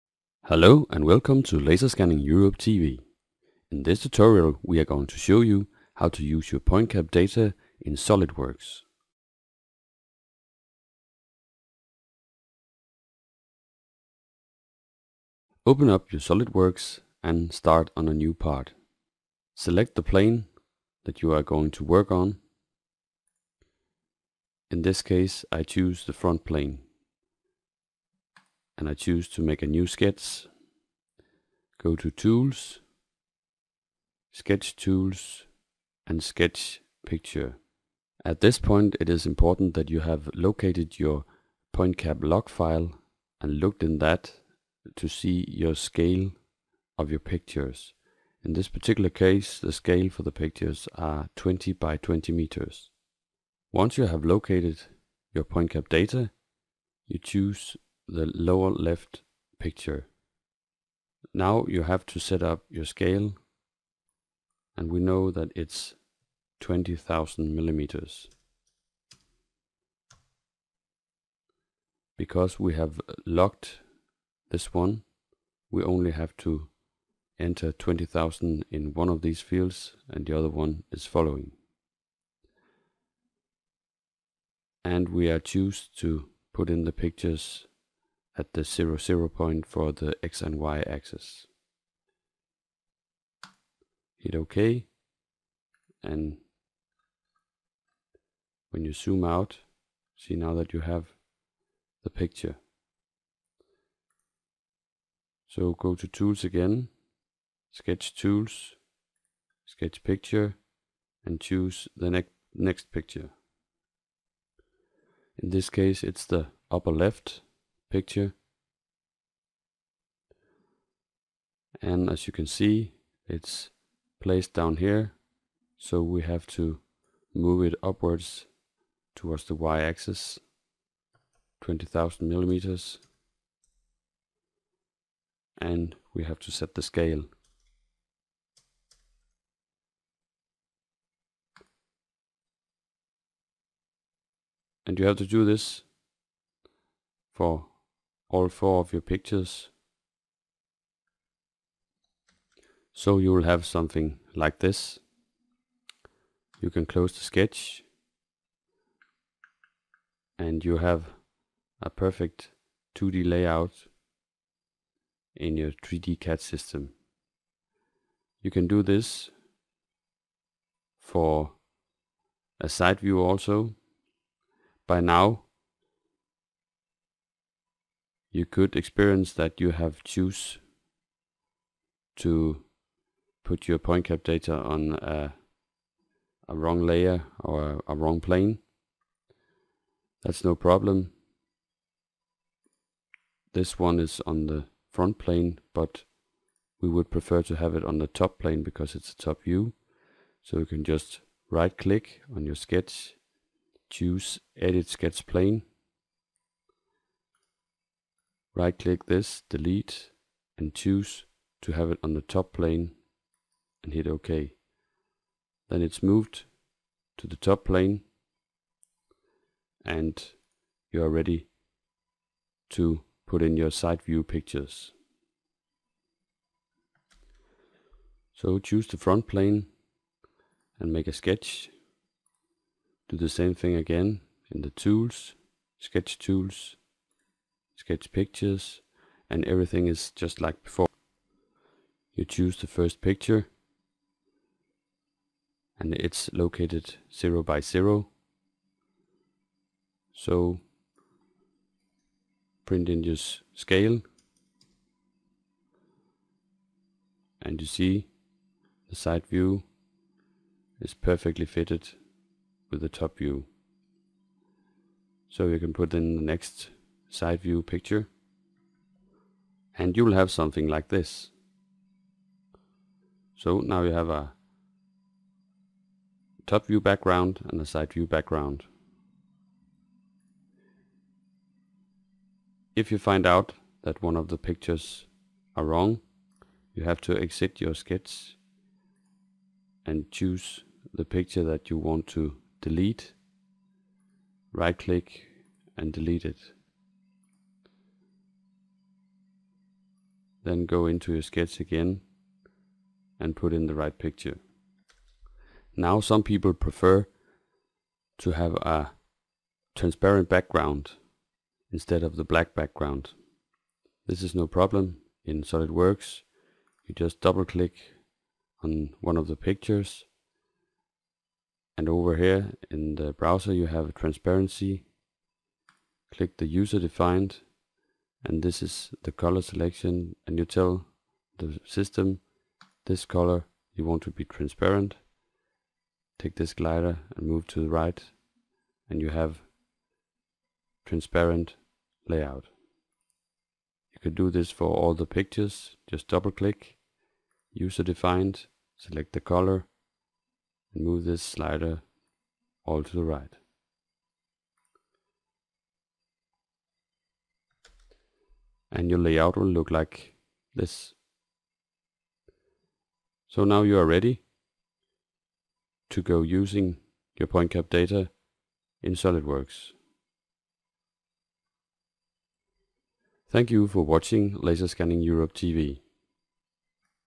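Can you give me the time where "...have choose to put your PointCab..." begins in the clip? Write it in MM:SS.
02:59.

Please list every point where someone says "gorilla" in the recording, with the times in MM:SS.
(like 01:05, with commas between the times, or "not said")
not said.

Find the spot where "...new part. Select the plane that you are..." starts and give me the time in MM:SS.
00:18.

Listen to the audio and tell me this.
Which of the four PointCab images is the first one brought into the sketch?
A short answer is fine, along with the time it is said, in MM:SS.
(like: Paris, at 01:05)
Lower left picture, at 00:58.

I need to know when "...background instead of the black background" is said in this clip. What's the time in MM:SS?
05:10.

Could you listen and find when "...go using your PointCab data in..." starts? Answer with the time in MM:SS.
06:06.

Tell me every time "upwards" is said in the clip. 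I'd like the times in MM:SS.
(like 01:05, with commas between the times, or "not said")
02:07.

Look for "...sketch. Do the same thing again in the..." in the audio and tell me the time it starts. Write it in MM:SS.
03:51.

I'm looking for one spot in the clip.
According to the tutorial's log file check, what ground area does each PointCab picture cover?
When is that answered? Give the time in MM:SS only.
00:51.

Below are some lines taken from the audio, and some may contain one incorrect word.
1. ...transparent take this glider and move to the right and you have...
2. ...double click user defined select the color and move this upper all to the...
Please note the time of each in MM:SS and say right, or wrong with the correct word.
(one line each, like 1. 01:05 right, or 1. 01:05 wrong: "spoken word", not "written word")
1. 05:34 right
2. 05:46 wrong: "slider", not "upper".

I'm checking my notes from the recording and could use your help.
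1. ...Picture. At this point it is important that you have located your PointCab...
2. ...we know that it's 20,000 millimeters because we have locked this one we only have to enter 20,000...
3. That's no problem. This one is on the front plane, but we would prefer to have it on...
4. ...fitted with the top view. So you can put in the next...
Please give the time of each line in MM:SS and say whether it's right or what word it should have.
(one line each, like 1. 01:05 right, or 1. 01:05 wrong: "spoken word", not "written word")
1. 00:37 right
2. 01:04 right
3. 03:10 right
4. 04:21 right.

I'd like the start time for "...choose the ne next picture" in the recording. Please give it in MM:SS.
01:51.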